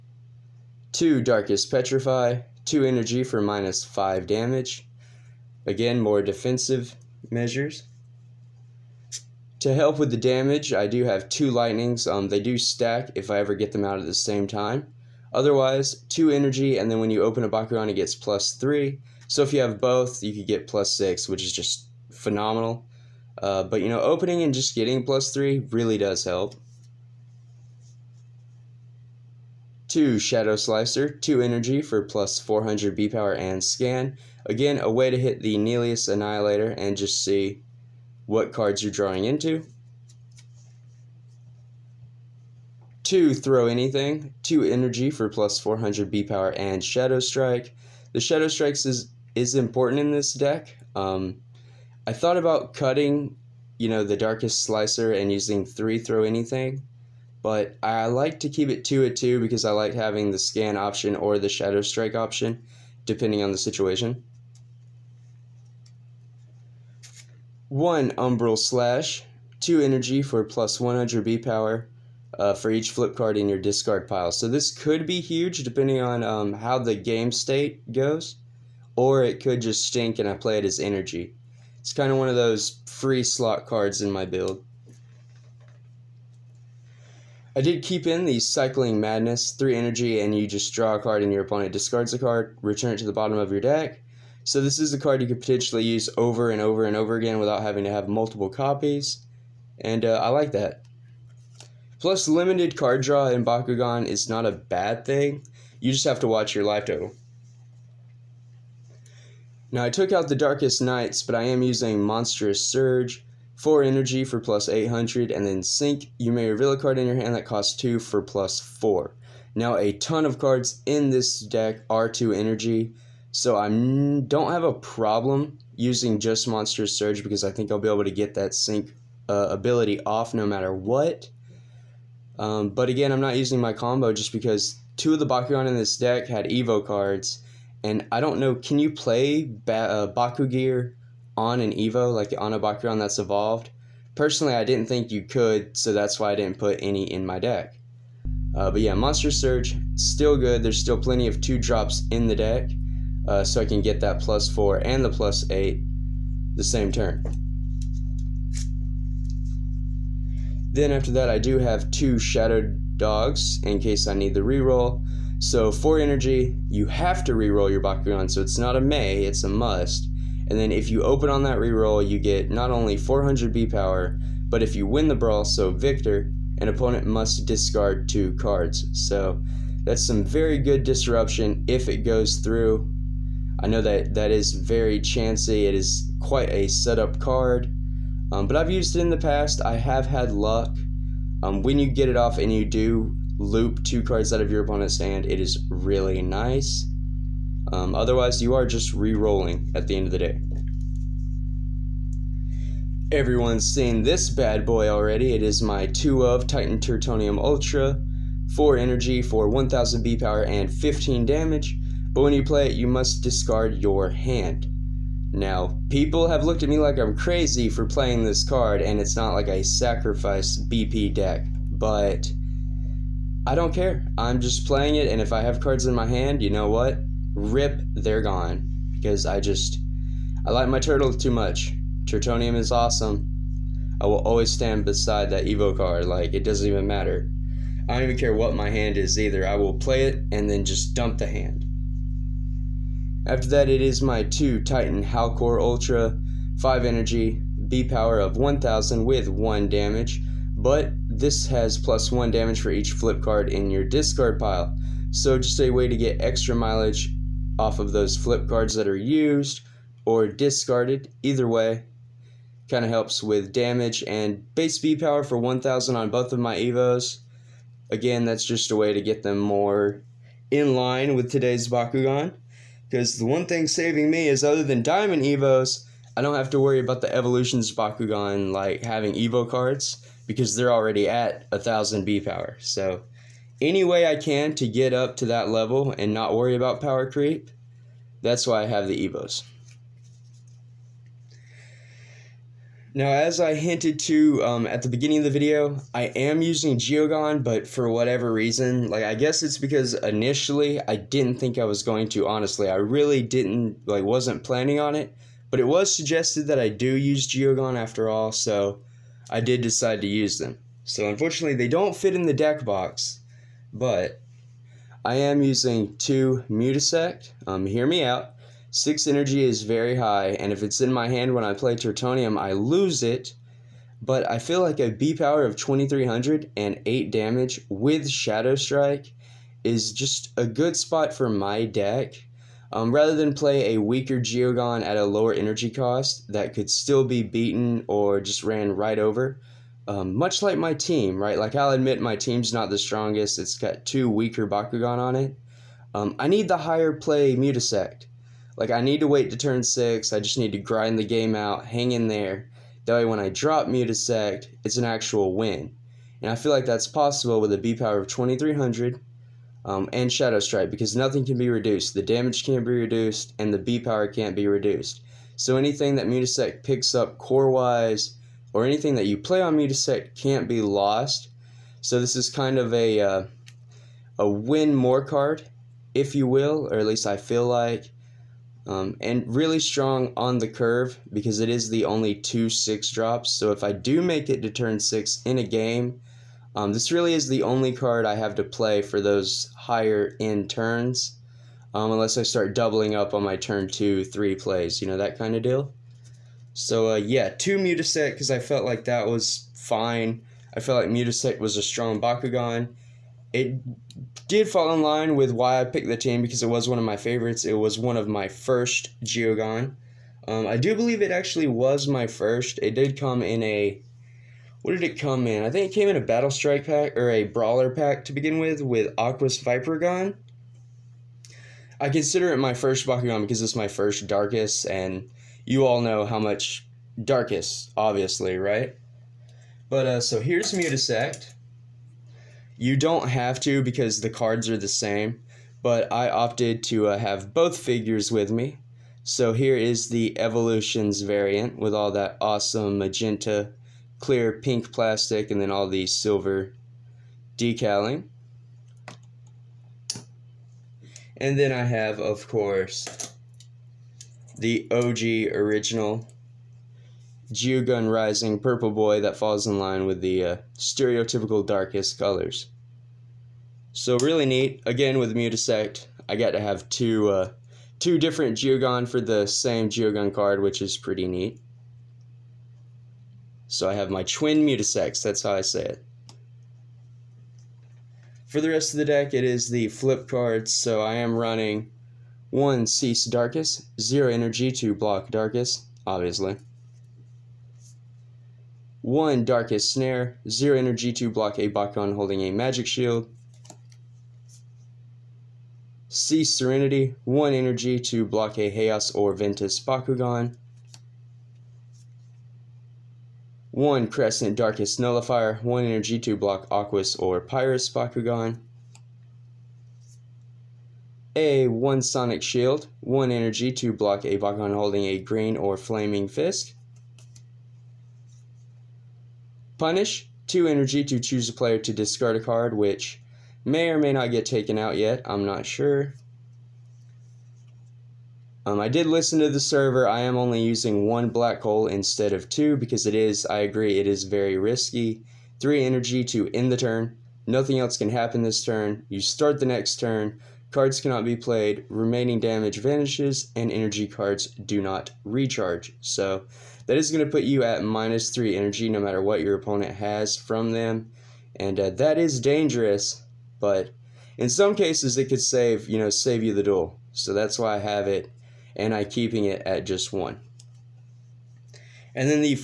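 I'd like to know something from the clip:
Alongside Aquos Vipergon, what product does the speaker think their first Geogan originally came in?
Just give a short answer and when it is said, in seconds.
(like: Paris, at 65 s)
Battle Strike pack, at 416 s.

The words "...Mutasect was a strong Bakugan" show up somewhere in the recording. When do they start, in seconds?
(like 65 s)
400 s.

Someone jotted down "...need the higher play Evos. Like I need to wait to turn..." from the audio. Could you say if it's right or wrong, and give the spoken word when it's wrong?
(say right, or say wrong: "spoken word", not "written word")
wrong: "Mutasect", not "Evos".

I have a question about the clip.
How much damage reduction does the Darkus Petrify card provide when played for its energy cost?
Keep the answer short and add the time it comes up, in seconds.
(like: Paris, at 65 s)
-5 damage, at 3 s.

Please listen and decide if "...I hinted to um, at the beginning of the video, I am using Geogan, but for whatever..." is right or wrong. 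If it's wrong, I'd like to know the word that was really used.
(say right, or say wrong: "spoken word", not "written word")
right.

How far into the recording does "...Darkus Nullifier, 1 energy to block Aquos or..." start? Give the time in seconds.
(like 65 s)
504 s.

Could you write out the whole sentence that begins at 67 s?
One umbral slash, two energy for plus 100 B power uh, for each flip card in your discard pile.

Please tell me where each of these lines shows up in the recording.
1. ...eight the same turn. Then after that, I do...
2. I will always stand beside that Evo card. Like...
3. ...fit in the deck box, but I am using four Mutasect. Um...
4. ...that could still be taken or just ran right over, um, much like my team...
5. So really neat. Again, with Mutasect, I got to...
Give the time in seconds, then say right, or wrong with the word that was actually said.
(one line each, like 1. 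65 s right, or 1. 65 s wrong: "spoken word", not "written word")
1. 155 s right
2. 233 s right
3. 311 s wrong: "two", not "four"
4. 336 s wrong: "beaten", not "taken"
5. 463 s right.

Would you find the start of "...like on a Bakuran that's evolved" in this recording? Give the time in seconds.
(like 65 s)
142 s.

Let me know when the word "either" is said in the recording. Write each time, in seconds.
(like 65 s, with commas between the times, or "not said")
239 s, 261 s.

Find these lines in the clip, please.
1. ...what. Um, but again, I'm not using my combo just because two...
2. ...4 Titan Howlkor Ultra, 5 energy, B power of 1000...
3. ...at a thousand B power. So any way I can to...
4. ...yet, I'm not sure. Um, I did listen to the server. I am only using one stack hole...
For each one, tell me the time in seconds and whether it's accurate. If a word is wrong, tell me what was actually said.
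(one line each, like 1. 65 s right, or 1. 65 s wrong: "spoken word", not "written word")
1. 130 s right
2. 244 s wrong: "2", not "4"
3. 281 s right
4. 524 s wrong: "black", not "stack".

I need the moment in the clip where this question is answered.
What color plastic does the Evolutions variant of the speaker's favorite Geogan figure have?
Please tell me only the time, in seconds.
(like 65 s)
442 s.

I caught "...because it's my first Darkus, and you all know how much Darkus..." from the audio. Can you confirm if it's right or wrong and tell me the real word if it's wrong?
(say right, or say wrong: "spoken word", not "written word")
right.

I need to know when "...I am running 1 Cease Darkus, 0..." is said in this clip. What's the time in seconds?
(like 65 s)
480 s.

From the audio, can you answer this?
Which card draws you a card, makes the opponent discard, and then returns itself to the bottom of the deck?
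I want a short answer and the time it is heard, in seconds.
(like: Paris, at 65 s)
Cycling Madness, at 88 s.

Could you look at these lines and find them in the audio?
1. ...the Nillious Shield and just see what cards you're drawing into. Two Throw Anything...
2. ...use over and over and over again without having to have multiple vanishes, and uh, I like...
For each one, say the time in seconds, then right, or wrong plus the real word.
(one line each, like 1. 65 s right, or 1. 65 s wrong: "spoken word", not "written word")
1. 35 s wrong: "Annihilator", not "Shield"
2. 95 s wrong: "copies", not "vanishes".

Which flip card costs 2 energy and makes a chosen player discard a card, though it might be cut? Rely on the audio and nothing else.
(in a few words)
Punish.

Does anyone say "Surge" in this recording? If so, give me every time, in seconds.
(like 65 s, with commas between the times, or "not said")
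112 s, 126 s, 149 s.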